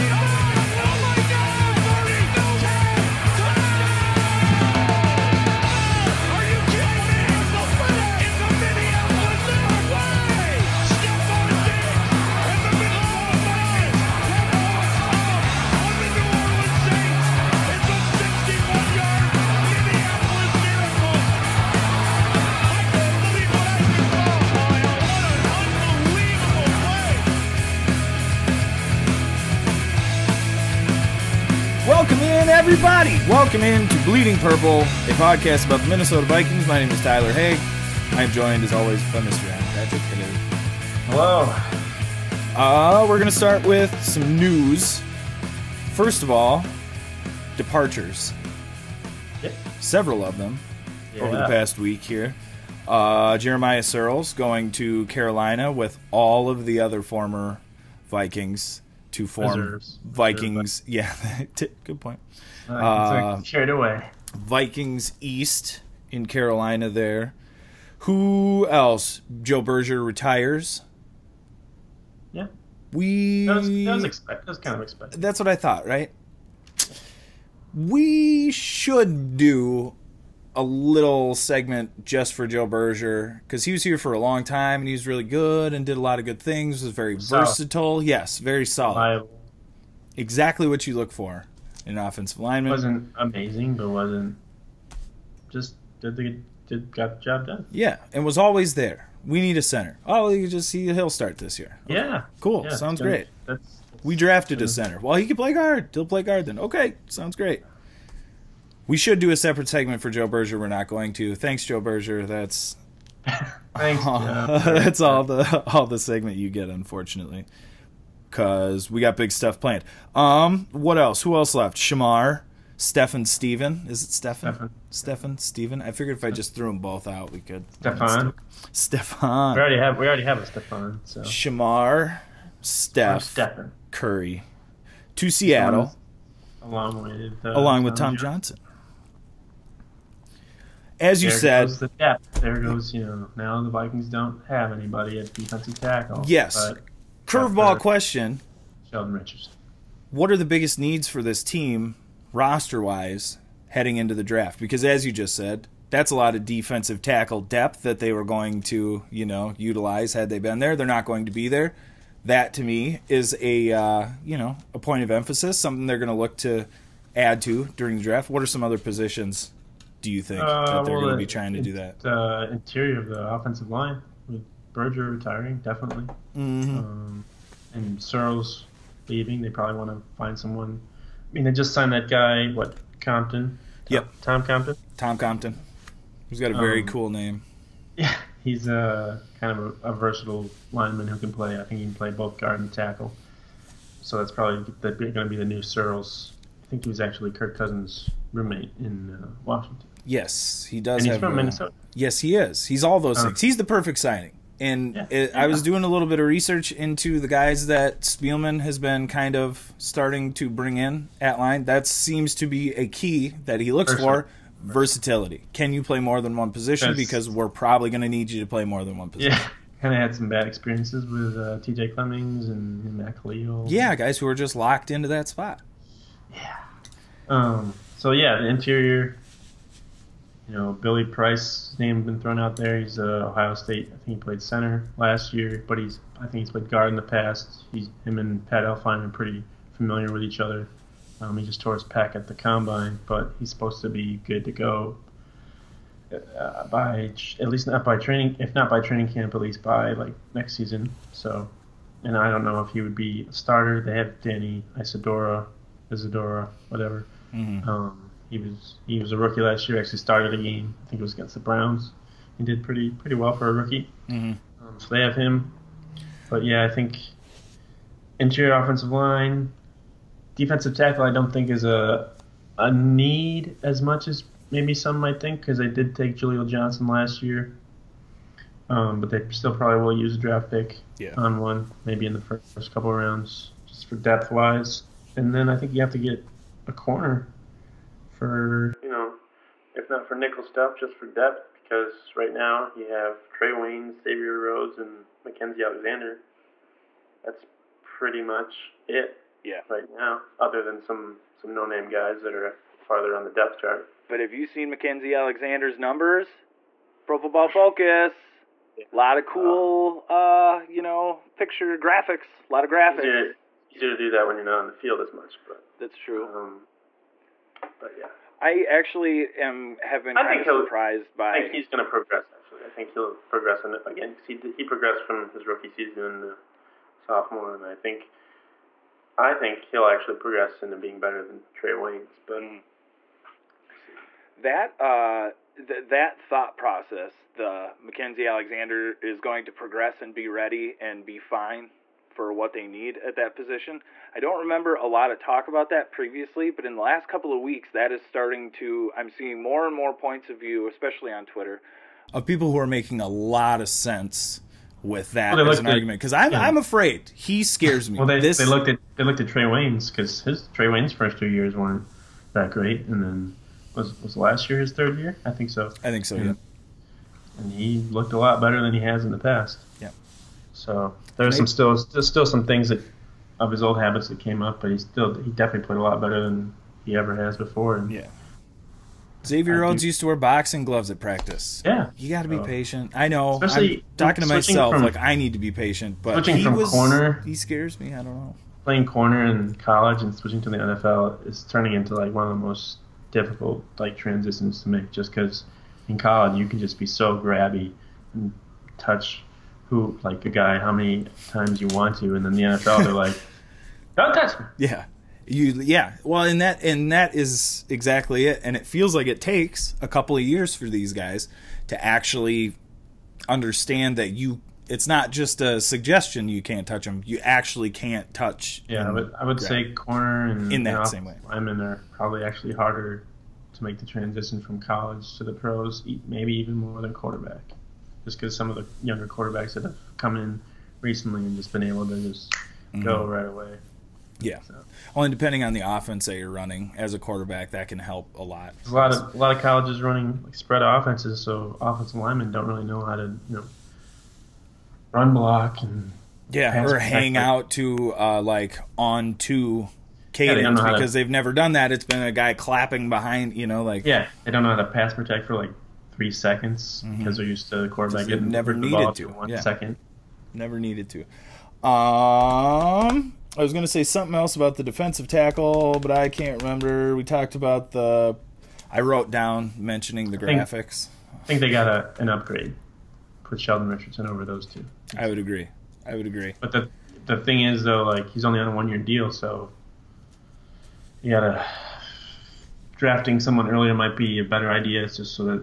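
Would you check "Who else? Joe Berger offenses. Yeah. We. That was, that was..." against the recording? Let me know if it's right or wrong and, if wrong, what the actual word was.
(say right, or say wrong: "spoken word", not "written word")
wrong: "retires", not "offenses".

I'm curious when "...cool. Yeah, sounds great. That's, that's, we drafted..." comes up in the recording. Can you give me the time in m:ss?
1:42.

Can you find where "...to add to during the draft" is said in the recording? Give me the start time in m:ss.
2:46.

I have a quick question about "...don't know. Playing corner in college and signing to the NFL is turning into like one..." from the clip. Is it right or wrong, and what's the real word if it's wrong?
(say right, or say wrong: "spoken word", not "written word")
wrong: "switching", not "signing".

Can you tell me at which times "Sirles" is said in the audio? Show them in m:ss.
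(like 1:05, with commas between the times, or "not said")
0:53, 2:57, 3:15.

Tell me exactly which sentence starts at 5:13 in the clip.
Easier to, easier to do that when you're not on the field as much, but that's true.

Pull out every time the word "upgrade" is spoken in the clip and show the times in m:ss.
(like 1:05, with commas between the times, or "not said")
7:52.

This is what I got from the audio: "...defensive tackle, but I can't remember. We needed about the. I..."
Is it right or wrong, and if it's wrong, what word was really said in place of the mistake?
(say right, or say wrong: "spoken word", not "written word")
wrong: "talked", not "needed".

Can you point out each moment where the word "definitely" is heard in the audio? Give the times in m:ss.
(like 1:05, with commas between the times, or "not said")
2:55, 6:15.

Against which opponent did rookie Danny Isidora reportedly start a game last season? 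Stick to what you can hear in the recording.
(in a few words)
Browns.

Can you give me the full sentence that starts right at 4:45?
And then I think you have to get a corner for you know, if not for nickel stuff, just for depth.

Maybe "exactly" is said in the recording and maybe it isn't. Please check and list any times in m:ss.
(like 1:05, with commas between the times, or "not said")
1:30, 6:47.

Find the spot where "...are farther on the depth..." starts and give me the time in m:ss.
5:02.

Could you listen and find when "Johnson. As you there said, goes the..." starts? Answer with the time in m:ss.
2:18.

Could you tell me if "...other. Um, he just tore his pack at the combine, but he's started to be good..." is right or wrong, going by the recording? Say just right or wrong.
wrong.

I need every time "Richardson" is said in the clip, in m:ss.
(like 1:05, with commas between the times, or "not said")
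2:29, 7:53.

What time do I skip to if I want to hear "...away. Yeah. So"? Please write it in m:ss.
7:13.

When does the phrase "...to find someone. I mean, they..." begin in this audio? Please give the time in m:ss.
2:59.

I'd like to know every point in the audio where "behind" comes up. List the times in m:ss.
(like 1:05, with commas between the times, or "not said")
7:32.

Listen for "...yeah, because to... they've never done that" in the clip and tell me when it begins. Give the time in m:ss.
7:30.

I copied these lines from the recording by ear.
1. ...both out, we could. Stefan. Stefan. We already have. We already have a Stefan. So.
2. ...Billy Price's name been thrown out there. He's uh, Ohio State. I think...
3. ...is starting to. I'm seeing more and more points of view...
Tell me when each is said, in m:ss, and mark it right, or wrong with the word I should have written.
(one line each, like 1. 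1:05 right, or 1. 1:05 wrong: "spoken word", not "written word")
1. 2:06 right
2. 3:50 right
3. 5:47 right.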